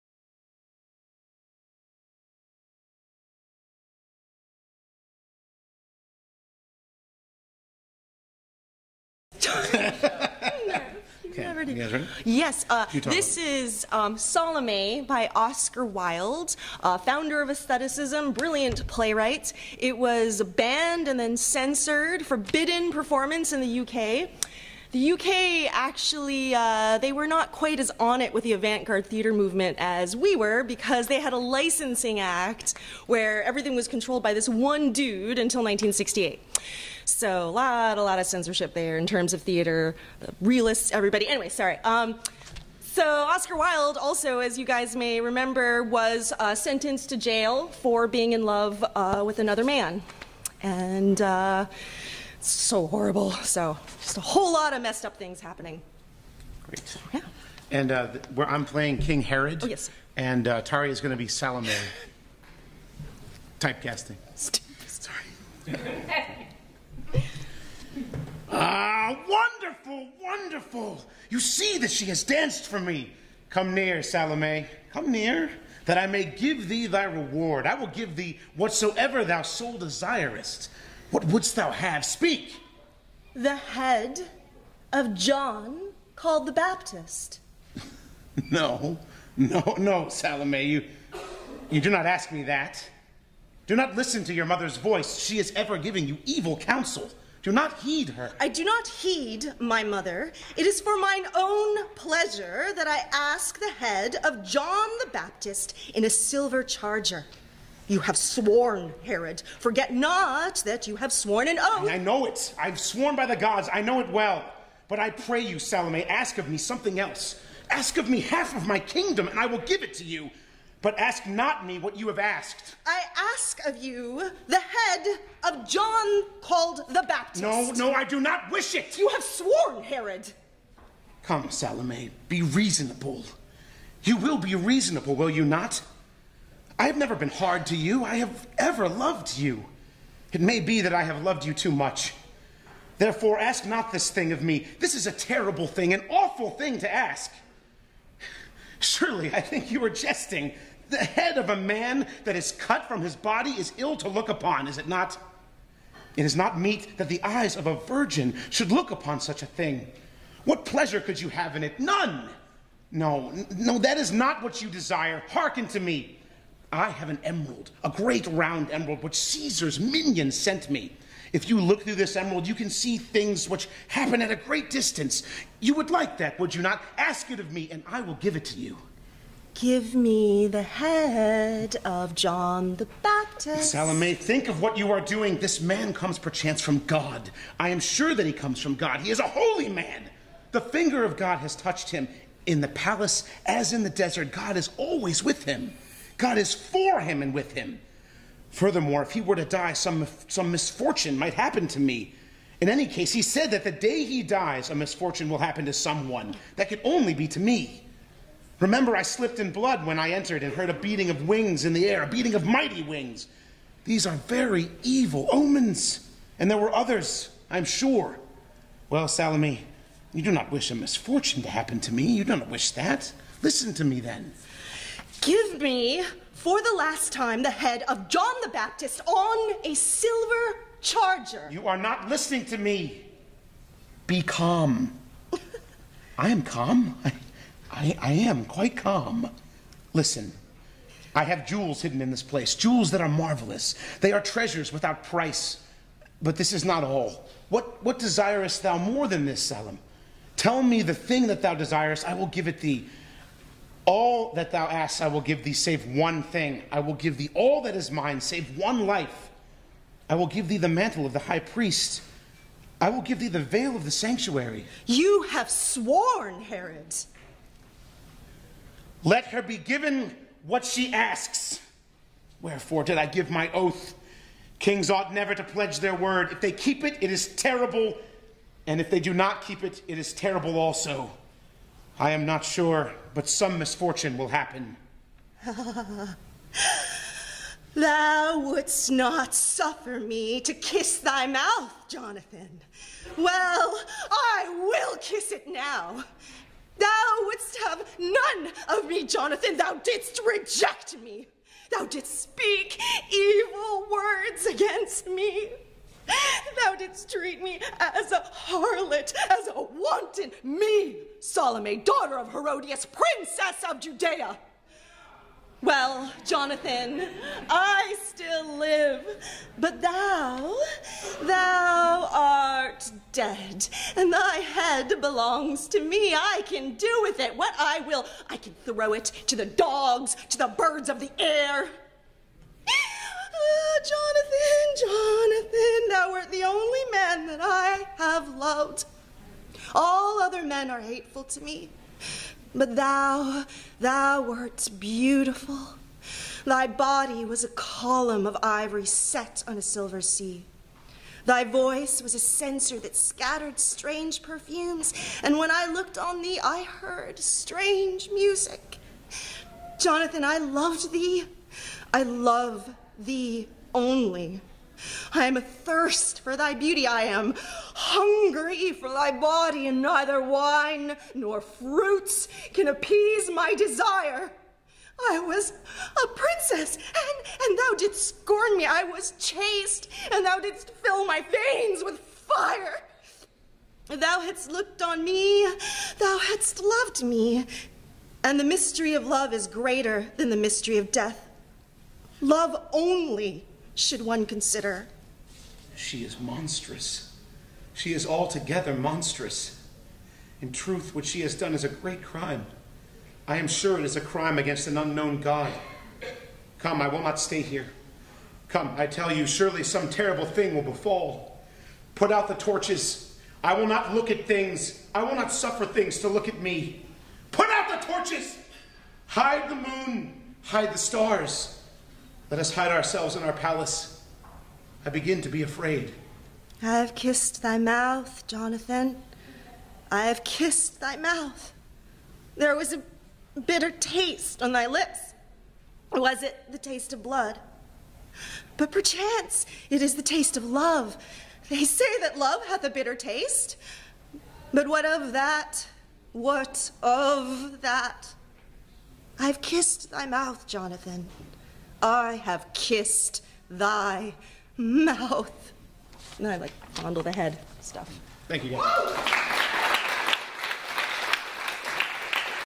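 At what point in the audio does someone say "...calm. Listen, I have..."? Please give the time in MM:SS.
03:58.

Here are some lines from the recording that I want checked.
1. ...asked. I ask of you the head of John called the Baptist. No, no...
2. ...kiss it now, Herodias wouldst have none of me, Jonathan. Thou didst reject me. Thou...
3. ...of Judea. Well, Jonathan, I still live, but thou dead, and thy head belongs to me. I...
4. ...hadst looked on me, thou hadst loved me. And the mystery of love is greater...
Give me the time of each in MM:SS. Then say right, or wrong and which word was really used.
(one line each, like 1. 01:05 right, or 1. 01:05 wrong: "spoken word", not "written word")
1. 02:02 right
2. 04:54 wrong: "Thou", not "Herodias"
3. 05:13 right
4. 06:24 right.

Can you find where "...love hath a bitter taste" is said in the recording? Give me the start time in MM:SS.
07:22.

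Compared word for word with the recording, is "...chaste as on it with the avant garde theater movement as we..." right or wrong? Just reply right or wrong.
wrong.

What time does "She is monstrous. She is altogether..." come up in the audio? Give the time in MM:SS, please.
06:35.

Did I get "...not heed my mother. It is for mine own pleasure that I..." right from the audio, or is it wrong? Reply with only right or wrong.
right.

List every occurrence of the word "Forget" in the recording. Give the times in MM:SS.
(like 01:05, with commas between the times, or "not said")
01:49.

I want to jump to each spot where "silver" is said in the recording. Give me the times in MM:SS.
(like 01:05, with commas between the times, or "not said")
01:46, 03:49, 05:49.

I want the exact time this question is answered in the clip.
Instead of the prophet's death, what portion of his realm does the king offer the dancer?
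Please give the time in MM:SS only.
01:58.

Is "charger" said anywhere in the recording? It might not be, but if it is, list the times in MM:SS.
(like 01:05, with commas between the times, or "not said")
01:46, 03:50.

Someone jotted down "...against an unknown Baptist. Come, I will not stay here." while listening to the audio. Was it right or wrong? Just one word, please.
wrong.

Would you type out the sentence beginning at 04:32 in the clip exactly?
Wherefore did I give my oath?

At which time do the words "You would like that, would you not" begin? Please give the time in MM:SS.
02:55.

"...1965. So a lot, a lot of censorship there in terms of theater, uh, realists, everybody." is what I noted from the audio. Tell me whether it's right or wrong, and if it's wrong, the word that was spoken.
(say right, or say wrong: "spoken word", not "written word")
wrong: "1968", not "1965".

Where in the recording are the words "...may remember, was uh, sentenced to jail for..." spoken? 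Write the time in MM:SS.
00:44.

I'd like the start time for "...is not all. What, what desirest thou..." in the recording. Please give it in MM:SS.
04:06.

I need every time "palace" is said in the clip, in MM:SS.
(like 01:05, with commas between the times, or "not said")
03:12, 07:03.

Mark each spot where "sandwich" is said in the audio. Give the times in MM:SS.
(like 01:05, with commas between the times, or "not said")
not said.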